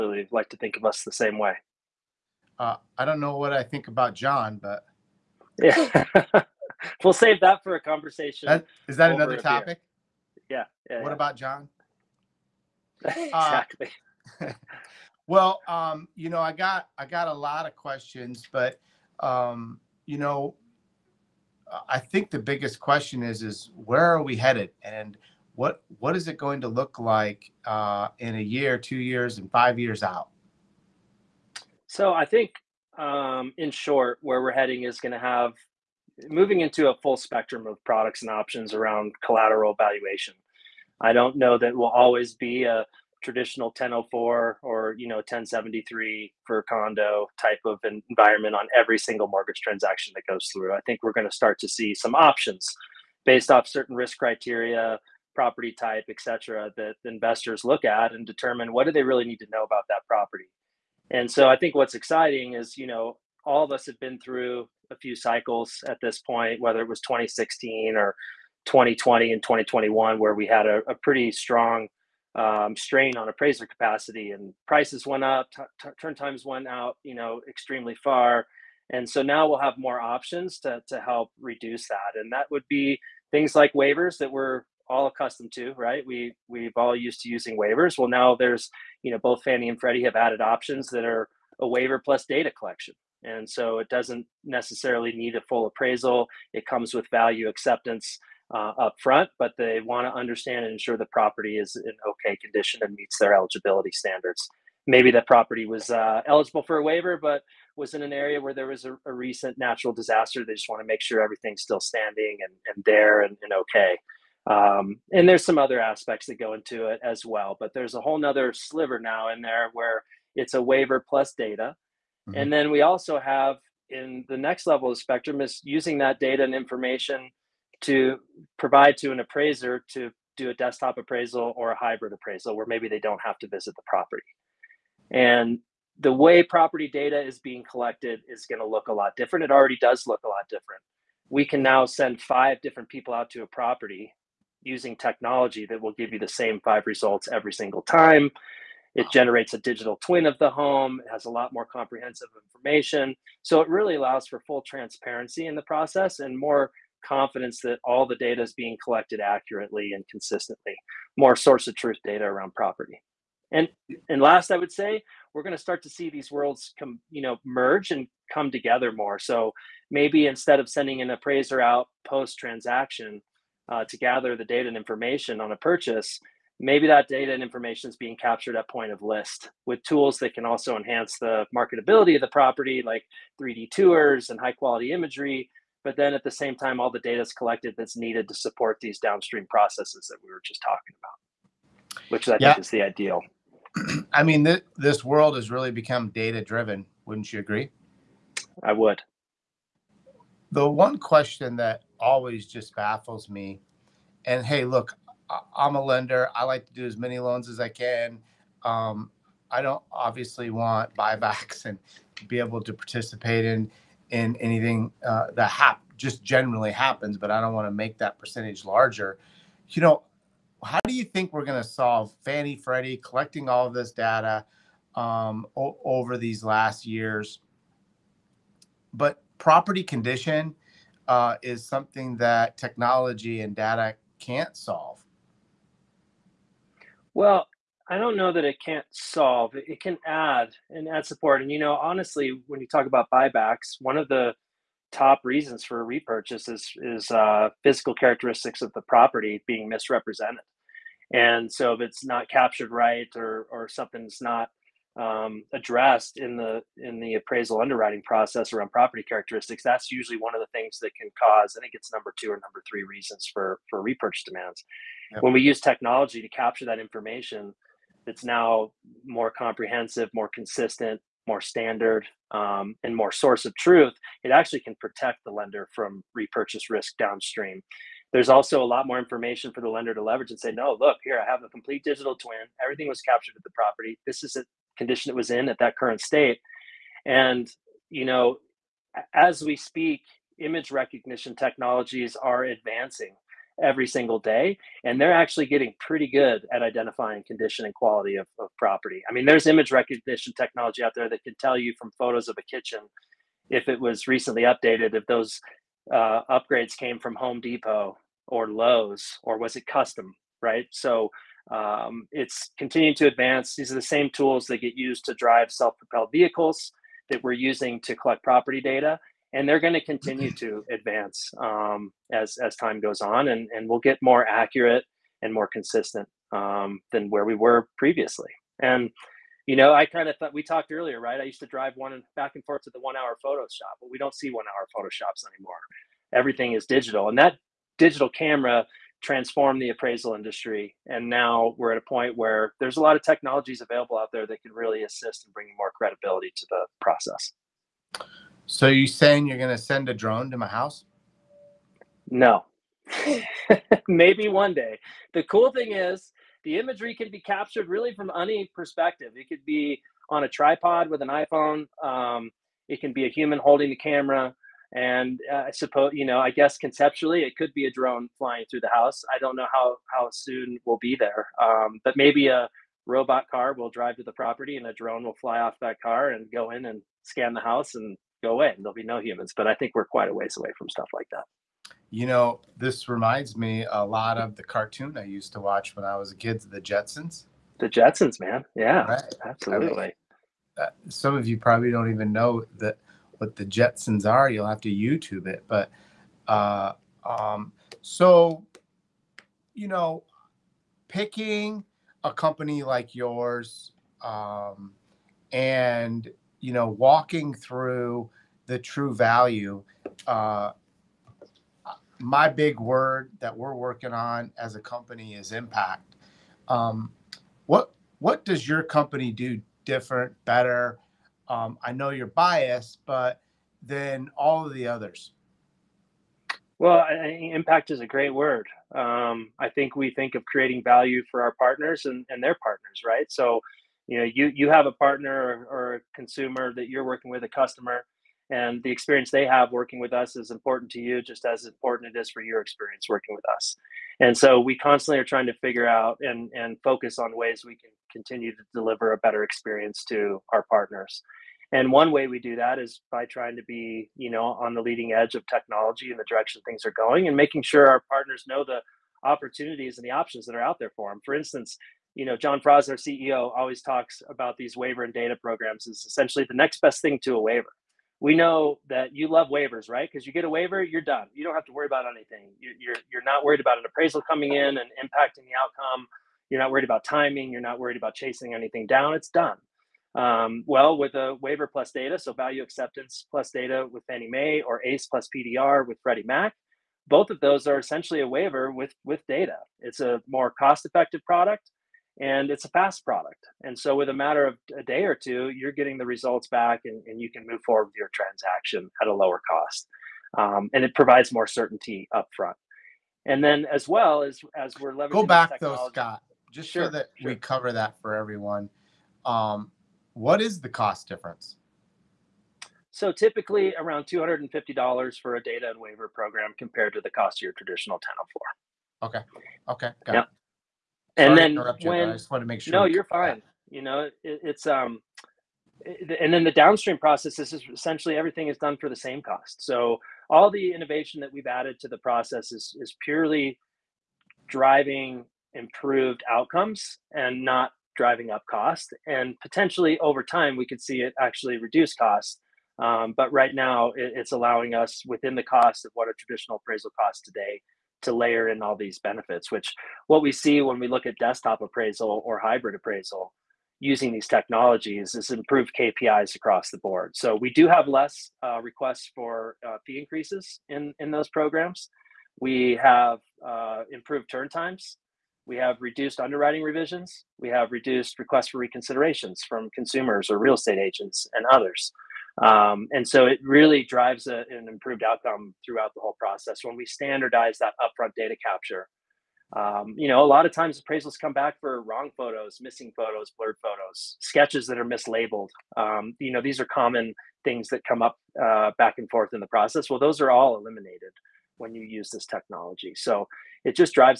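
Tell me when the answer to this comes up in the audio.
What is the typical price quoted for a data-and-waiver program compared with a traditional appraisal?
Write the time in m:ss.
8:33.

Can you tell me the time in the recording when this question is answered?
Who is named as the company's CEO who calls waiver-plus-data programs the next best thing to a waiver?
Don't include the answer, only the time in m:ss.
7:42.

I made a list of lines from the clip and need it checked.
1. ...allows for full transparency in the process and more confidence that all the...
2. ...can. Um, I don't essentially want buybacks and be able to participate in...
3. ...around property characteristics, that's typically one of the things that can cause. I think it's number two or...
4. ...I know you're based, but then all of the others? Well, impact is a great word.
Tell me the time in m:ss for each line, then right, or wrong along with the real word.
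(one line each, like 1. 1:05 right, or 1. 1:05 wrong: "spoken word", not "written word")
1. 2:33 right
2. 3:27 wrong: "obviously", not "essentially"
3. 4:18 wrong: "usually", not "typically"
4. 7:01 wrong: "biased", not "based".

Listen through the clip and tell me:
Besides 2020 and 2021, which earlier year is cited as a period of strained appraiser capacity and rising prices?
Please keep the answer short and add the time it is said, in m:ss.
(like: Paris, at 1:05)
2016, at 1:06.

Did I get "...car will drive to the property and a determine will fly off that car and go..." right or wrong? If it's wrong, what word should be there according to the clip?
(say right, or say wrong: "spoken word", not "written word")
wrong: "drone", not "determine".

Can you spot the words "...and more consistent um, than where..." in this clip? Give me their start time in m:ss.
5:25.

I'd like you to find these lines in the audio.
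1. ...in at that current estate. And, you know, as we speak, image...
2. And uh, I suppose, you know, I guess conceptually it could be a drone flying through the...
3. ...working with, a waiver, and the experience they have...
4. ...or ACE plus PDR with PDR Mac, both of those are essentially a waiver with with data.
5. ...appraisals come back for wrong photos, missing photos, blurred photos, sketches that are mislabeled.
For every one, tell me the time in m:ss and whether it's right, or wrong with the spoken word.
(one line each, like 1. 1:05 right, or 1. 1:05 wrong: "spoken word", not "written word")
1. 4:45 wrong: "state", not "estate"
2. 6:04 right
3. 7:16 wrong: "customer", not "waiver"
4. 8:04 wrong: "Freddie", not "PDR"
5. 9:40 right.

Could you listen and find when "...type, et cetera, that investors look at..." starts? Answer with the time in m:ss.
0:55.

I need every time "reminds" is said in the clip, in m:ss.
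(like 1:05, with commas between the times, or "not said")
6:22.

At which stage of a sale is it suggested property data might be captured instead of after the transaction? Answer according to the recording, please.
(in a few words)
point of list.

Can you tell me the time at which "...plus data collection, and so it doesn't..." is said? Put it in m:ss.
1:32.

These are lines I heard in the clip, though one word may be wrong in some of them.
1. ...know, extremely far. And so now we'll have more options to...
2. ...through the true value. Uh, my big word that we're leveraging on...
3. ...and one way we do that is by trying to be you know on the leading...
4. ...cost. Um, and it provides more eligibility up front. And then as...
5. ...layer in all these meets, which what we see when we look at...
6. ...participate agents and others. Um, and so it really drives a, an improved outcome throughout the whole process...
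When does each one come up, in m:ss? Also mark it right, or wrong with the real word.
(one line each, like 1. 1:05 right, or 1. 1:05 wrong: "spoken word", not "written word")
1. 1:17 right
2. 6:47 wrong: "working", not "leveraging"
3. 7:31 right
4. 8:19 wrong: "certainty", not "eligibility"
5. 9:07 wrong: "benefits", not "meets"
6. 9:30 wrong: "estate", not "participate".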